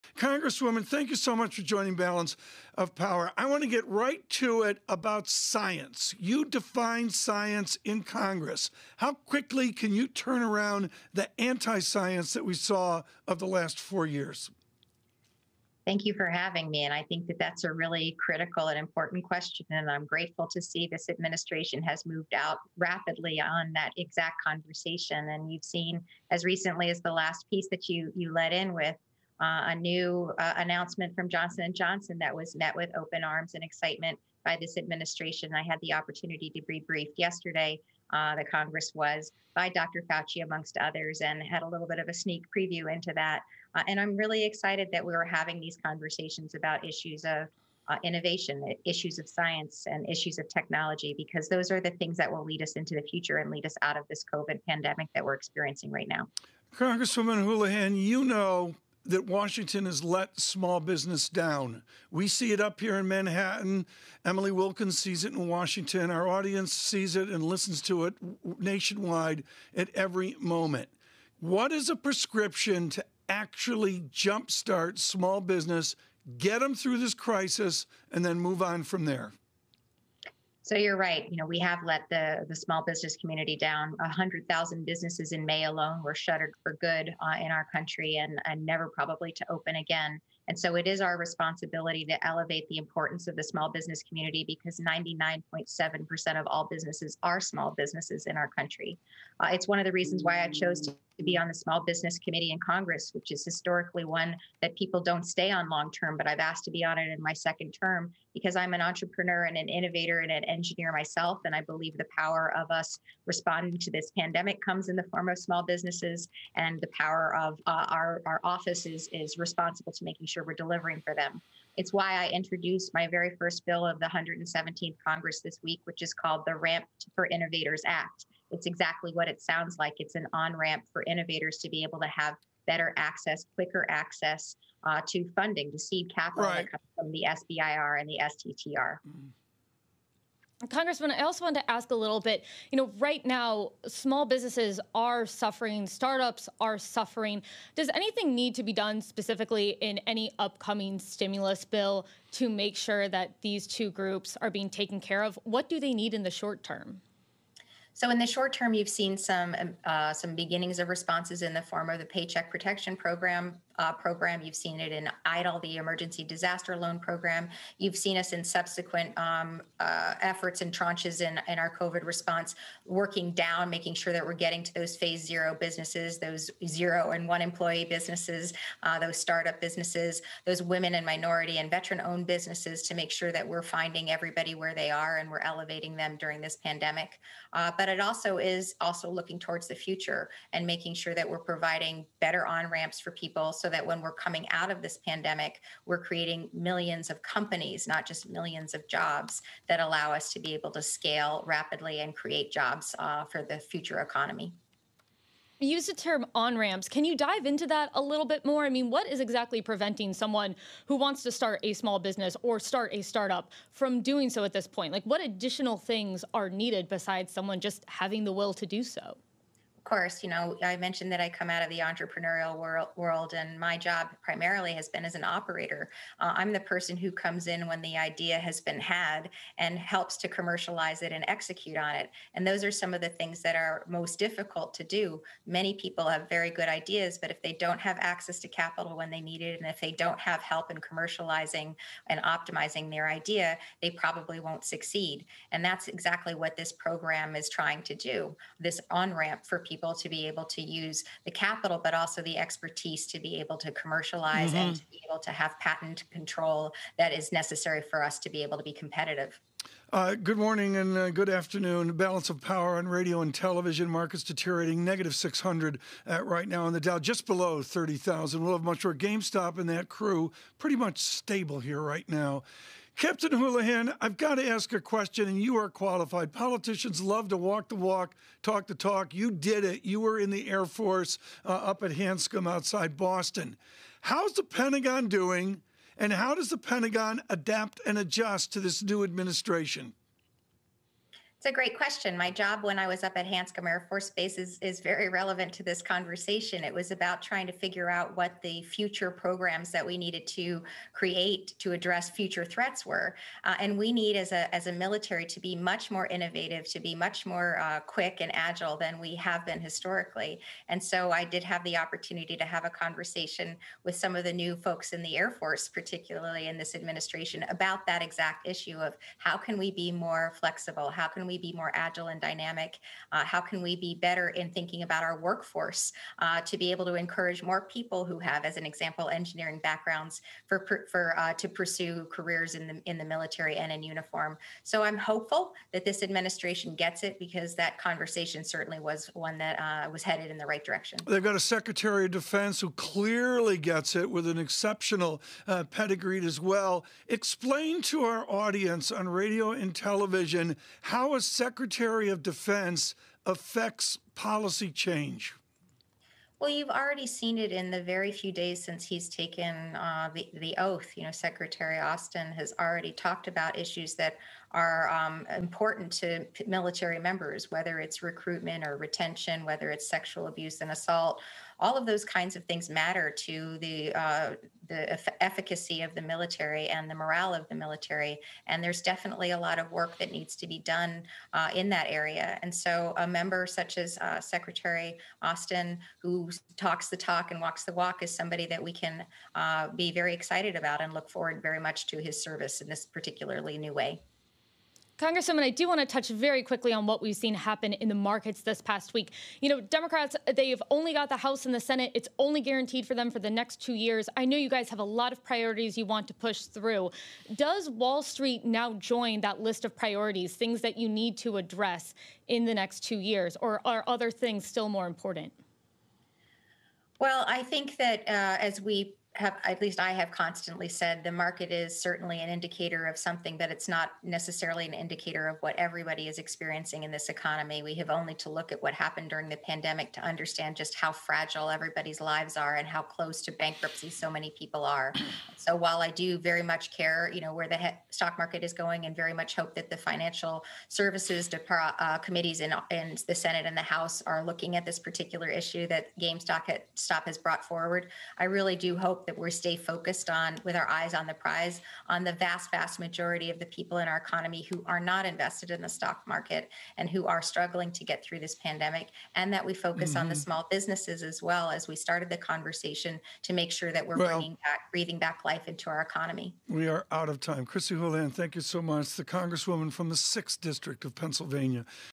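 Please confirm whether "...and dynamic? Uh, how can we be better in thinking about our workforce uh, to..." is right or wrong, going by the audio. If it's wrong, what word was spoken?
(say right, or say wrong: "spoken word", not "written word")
right.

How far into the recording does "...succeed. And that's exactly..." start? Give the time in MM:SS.
04:04.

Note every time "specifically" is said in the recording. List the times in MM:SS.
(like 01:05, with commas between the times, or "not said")
02:29.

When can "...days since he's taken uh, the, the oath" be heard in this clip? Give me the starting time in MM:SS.
05:58.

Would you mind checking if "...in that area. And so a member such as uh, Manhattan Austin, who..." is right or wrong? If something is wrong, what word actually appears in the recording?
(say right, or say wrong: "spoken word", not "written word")
wrong: "Secretary", not "Manhattan".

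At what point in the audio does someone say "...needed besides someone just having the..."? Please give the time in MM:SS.
03:36.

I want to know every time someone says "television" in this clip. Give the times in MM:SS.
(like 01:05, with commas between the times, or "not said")
04:23, 05:49.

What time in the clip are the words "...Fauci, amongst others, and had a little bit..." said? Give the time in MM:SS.
00:40.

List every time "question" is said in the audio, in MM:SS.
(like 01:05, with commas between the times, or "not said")
00:19, 04:34, 04:51.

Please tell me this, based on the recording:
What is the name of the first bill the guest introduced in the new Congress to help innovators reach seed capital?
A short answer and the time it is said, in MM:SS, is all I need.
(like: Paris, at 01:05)
Ramp for Innovators Act, at 02:06.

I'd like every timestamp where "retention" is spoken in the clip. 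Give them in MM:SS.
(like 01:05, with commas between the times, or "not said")
06:08.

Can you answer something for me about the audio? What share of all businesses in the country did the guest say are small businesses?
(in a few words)
99.7%.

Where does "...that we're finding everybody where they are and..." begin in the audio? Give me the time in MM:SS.
03:03.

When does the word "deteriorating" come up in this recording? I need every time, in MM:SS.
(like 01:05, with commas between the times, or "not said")
04:24.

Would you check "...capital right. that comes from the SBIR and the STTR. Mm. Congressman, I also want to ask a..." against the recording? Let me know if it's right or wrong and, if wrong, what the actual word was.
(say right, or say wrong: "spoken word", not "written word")
right.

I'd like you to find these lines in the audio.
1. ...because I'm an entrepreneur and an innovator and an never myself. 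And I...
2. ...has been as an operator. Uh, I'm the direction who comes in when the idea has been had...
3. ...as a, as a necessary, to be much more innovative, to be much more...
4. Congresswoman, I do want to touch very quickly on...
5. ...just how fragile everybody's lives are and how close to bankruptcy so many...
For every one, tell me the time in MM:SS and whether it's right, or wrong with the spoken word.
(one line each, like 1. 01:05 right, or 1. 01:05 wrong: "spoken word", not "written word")
1. 01:48 wrong: "engineer", not "never"
2. 03:44 wrong: "person", not "direction"
3. 05:04 wrong: "military", not "necessary"
4. 06:35 right
5. 07:10 right.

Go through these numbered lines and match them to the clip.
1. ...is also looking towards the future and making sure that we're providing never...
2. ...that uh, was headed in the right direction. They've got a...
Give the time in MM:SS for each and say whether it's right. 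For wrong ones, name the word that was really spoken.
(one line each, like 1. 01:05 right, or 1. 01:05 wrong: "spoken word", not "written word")
1. 03:08 wrong: "better", not "never"
2. 05:39 right.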